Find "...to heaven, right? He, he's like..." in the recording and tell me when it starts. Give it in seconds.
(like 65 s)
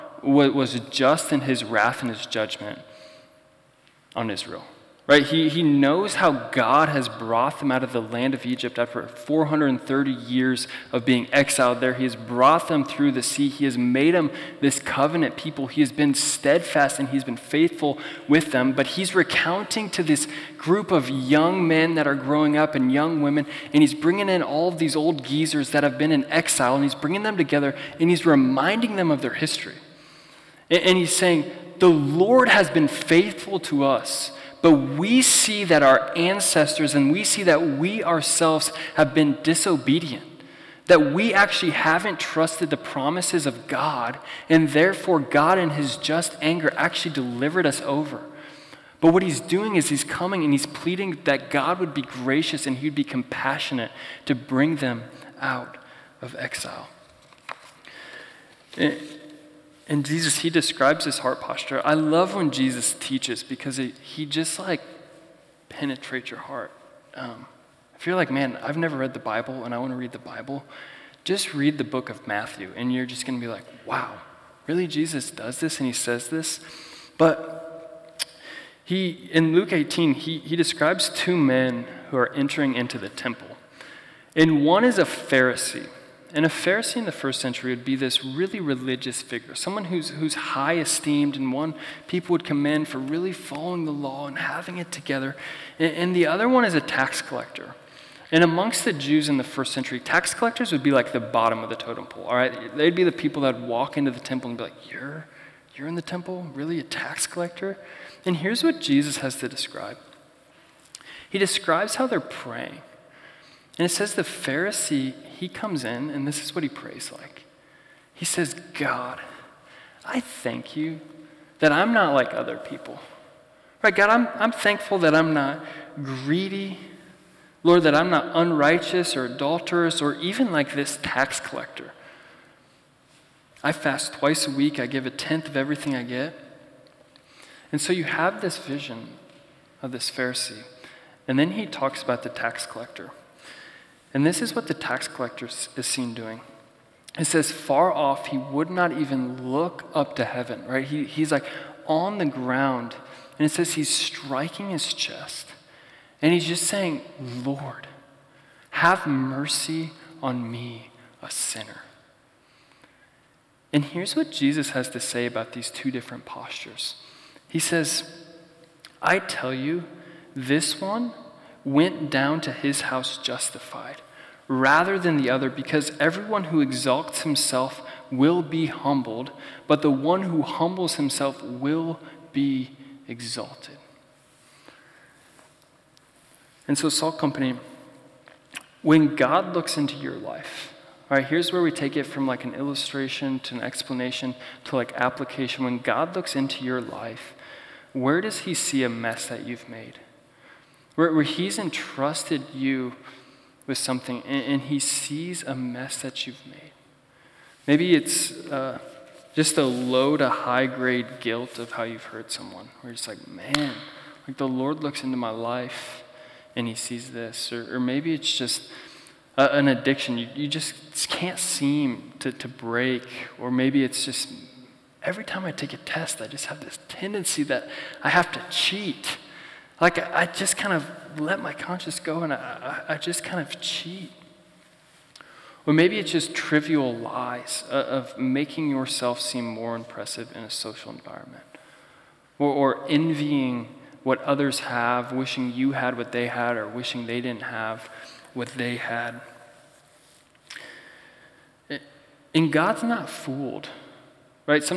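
150 s.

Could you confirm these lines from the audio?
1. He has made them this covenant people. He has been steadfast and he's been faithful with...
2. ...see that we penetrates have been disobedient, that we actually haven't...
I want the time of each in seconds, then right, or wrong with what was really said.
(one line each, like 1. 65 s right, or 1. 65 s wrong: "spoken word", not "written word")
1. 13 s right
2. 37 s wrong: "ourselves", not "penetrates".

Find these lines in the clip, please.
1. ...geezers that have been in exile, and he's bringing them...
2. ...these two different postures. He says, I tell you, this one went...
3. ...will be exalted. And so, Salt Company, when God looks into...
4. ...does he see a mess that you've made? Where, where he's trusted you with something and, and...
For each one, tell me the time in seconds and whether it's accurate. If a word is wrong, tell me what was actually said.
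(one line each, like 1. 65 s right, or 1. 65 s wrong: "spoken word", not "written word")
1. 25 s right
2. 165 s right
3. 181 s right
4. 198 s wrong: "entrusted", not "trusted".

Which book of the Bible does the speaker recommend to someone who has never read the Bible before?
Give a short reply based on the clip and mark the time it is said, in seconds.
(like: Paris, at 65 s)
Matthew, at 71 s.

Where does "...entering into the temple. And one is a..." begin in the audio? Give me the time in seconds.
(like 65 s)
82 s.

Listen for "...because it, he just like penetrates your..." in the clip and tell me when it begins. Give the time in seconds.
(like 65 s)
63 s.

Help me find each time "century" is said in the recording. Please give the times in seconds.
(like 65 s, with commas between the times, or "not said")
87 s, 99 s.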